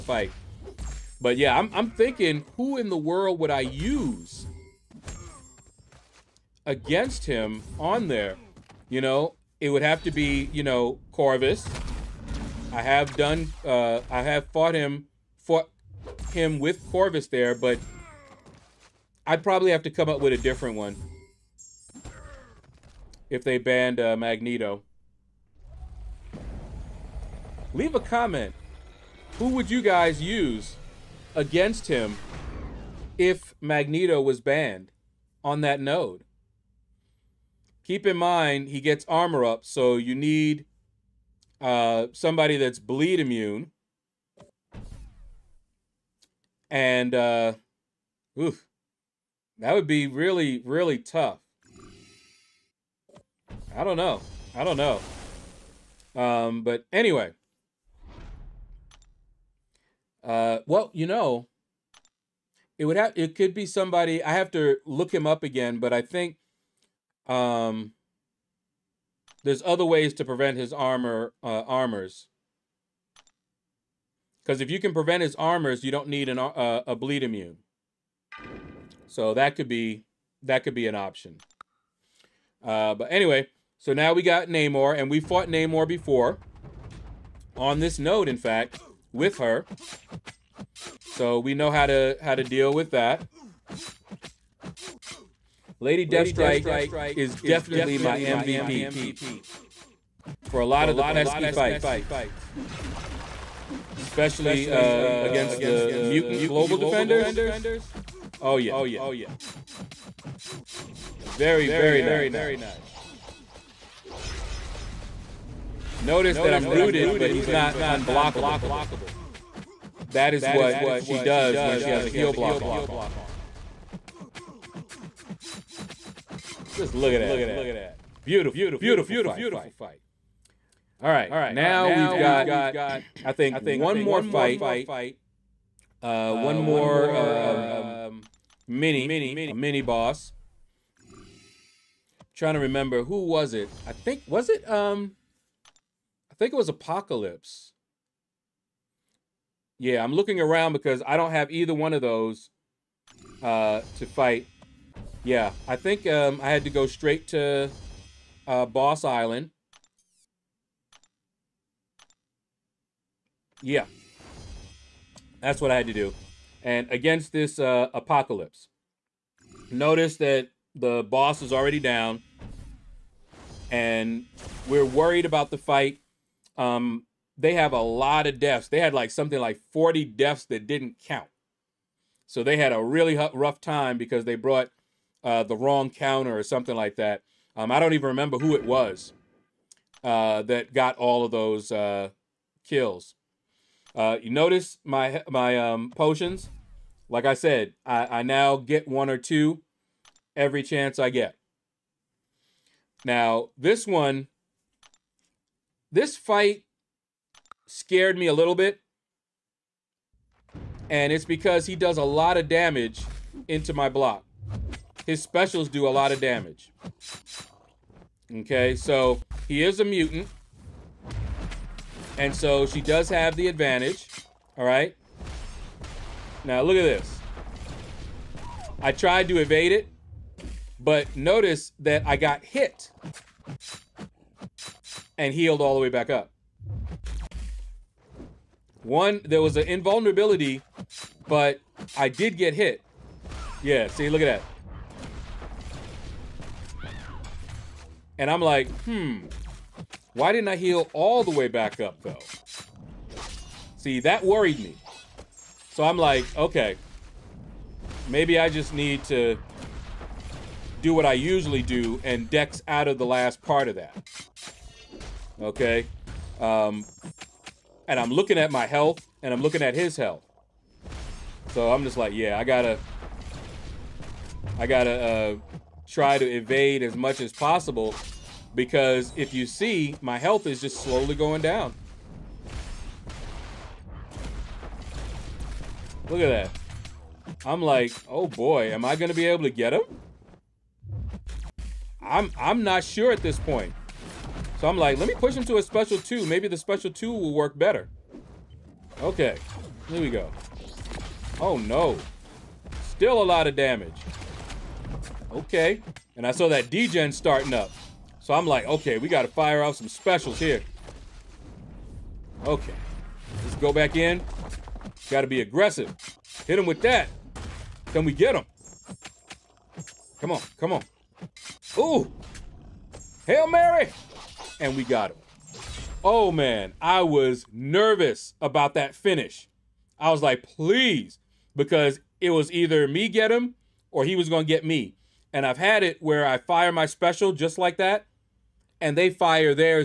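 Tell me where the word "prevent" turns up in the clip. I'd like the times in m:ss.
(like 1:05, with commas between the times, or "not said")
1:10, 1:14.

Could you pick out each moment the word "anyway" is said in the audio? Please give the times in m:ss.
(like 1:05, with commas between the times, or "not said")
0:56, 1:23.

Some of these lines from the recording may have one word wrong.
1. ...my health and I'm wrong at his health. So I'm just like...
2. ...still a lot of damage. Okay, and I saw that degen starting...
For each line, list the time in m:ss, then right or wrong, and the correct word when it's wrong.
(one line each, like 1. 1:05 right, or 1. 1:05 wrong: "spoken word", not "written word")
1. 4:28 wrong: "looking", not "wrong"
2. 5:02 right.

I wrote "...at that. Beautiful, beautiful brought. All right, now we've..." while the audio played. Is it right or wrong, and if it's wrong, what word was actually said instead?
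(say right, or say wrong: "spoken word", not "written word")
wrong: "fight", not "brought".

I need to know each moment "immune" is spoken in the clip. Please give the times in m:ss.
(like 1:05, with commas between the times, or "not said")
0:43, 1:17.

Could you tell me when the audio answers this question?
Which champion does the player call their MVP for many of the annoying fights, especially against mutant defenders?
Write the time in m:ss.
1:35.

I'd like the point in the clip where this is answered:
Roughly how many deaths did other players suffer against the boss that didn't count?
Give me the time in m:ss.
2:59.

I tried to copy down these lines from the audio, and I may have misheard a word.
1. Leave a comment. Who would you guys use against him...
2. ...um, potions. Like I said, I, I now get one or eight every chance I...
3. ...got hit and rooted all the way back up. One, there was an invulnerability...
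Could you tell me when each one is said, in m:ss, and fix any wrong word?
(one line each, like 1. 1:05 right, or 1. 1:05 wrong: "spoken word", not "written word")
1. 0:27 right
2. 3:15 wrong: "two", not "eight"
3. 3:52 wrong: "healed", not "rooted".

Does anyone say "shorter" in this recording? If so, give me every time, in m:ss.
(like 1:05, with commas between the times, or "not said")
not said.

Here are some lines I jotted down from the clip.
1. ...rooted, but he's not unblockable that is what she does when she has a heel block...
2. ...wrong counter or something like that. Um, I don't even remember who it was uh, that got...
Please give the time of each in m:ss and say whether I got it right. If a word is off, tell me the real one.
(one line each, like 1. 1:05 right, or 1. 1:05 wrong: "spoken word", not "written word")
1. 1:56 right
2. 3:05 right.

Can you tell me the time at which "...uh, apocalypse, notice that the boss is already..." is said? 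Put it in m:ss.
2:47.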